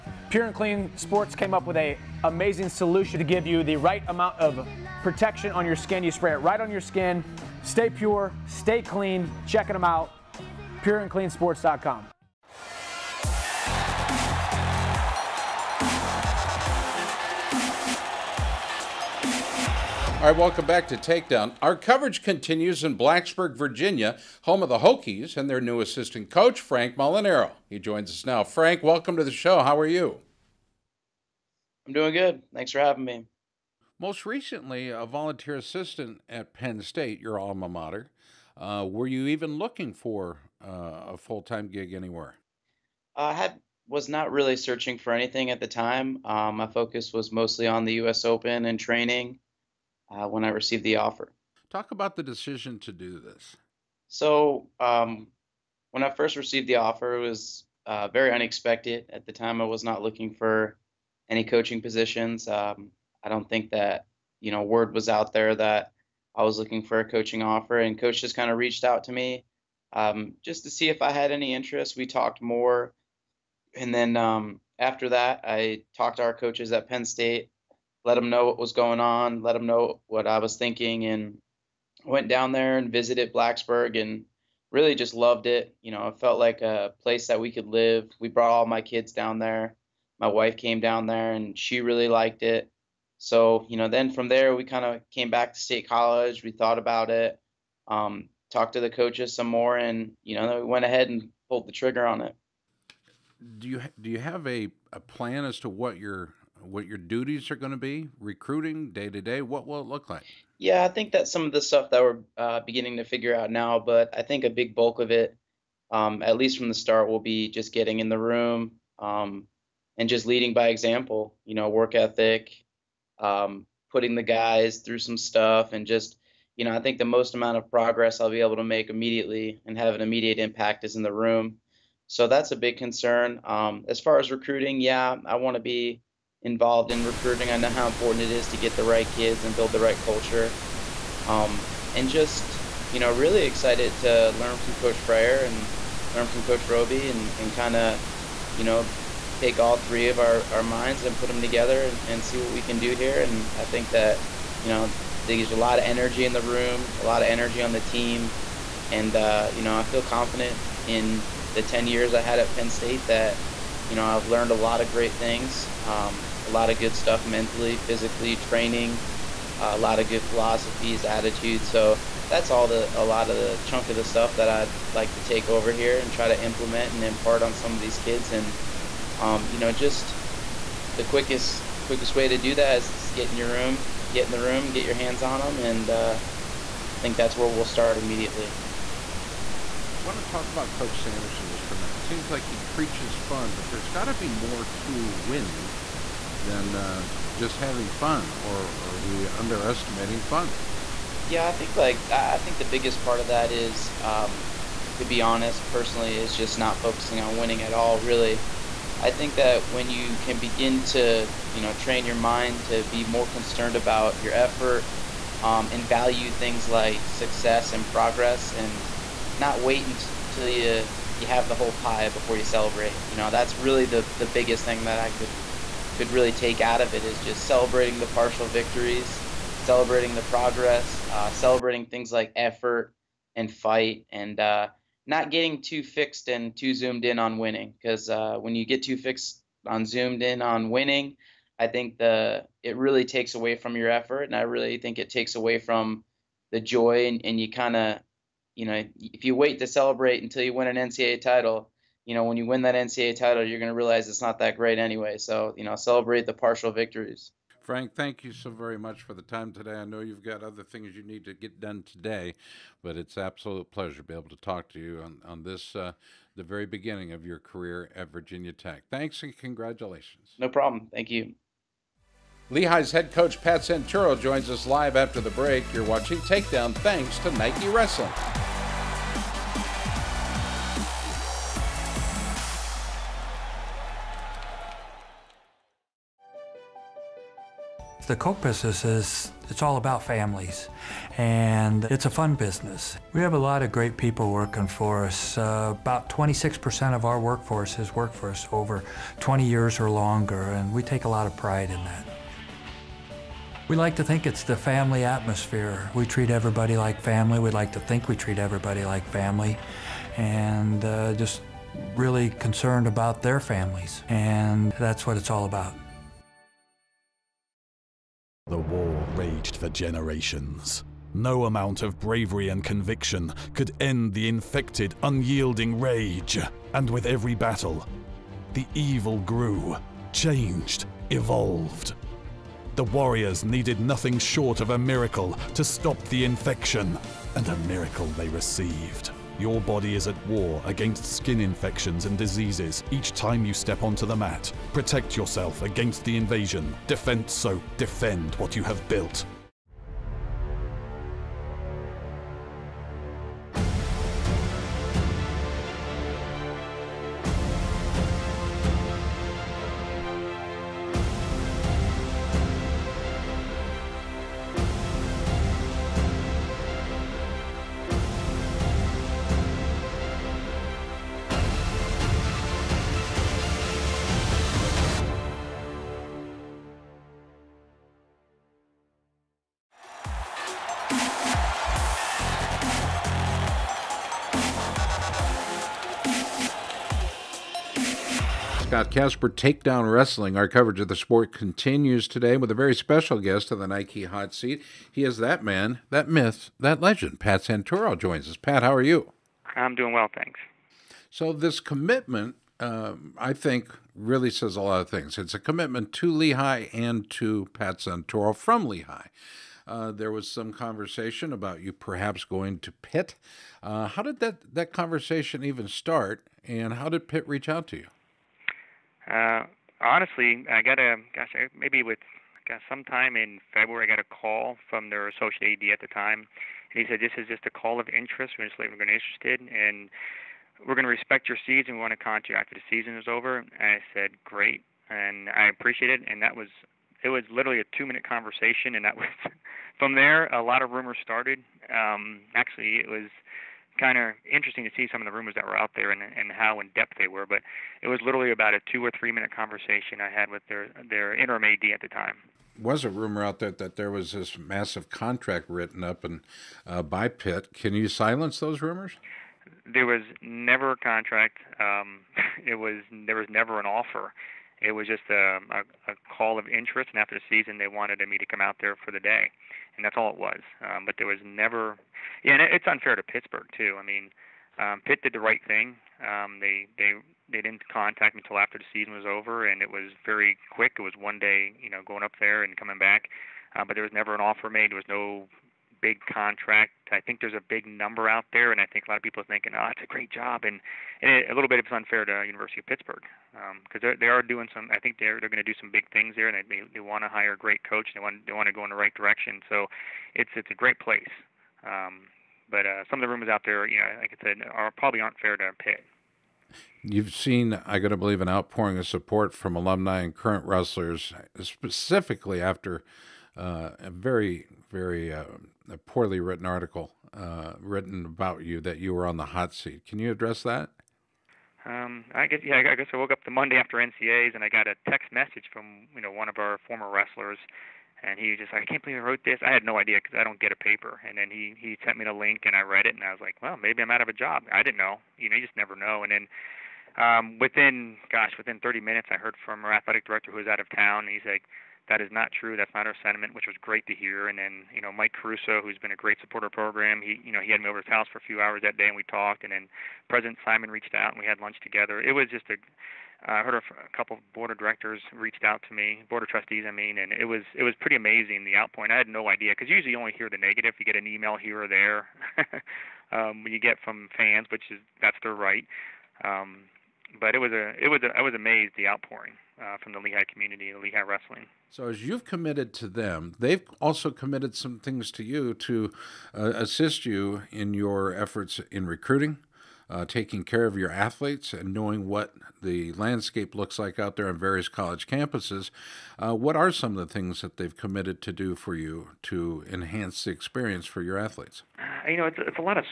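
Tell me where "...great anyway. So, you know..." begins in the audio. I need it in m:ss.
4:14.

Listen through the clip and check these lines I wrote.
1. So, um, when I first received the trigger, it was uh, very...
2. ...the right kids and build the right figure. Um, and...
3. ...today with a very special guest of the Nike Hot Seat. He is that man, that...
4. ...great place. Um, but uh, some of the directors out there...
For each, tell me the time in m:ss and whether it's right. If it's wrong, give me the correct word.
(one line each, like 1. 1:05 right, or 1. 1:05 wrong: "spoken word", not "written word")
1. 0:54 wrong: "offer", not "trigger"
2. 2:18 wrong: "culture", not "figure"
3. 6:32 right
4. 8:20 wrong: "rumors", not "directors".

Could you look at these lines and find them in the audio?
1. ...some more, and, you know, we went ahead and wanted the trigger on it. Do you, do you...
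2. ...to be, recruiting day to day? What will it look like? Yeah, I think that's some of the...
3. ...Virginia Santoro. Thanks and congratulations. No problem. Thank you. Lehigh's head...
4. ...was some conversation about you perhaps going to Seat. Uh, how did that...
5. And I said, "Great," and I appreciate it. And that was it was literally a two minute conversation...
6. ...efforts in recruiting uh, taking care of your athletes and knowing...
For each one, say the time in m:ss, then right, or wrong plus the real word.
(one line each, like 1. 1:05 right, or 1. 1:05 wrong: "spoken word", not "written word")
1. 1:39 wrong: "pulled", not "wanted"
2. 1:47 right
3. 4:28 wrong: "Tech", not "Santoro"
4. 6:50 wrong: "Pitt", not "Seat"
5. 7:13 right
6. 9:38 right.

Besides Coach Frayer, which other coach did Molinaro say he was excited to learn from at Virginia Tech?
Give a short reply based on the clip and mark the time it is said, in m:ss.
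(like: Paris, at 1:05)
Coach Robie, at 2:26.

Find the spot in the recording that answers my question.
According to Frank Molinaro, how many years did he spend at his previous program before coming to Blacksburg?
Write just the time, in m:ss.
2:41.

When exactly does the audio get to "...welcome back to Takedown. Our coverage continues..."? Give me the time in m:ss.
0:20.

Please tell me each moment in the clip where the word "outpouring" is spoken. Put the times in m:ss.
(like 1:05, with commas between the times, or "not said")
8:28, 9:18, 9:28.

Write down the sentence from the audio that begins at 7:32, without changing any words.
Was a rumor out there that there was this massive contract written up and uh, by Pitt.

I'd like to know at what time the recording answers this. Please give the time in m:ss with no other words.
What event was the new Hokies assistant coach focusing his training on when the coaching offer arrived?
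0:47.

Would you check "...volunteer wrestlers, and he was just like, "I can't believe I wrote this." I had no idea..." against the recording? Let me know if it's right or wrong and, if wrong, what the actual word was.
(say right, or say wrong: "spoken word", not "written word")
wrong: "former", not "volunteer".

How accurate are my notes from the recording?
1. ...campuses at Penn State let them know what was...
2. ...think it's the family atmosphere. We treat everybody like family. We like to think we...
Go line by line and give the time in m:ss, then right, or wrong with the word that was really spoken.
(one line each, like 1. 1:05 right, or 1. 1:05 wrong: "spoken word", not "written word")
1. 1:16 wrong: "coaches", not "campuses"
2. 5:04 right.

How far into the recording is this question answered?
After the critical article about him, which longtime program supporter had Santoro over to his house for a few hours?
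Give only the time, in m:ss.
9:04.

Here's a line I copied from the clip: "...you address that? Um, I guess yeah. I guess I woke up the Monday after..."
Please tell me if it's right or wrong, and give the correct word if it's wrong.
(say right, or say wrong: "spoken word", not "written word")
right.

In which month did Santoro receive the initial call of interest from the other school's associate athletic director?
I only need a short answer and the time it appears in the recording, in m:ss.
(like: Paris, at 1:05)
February, at 7:03.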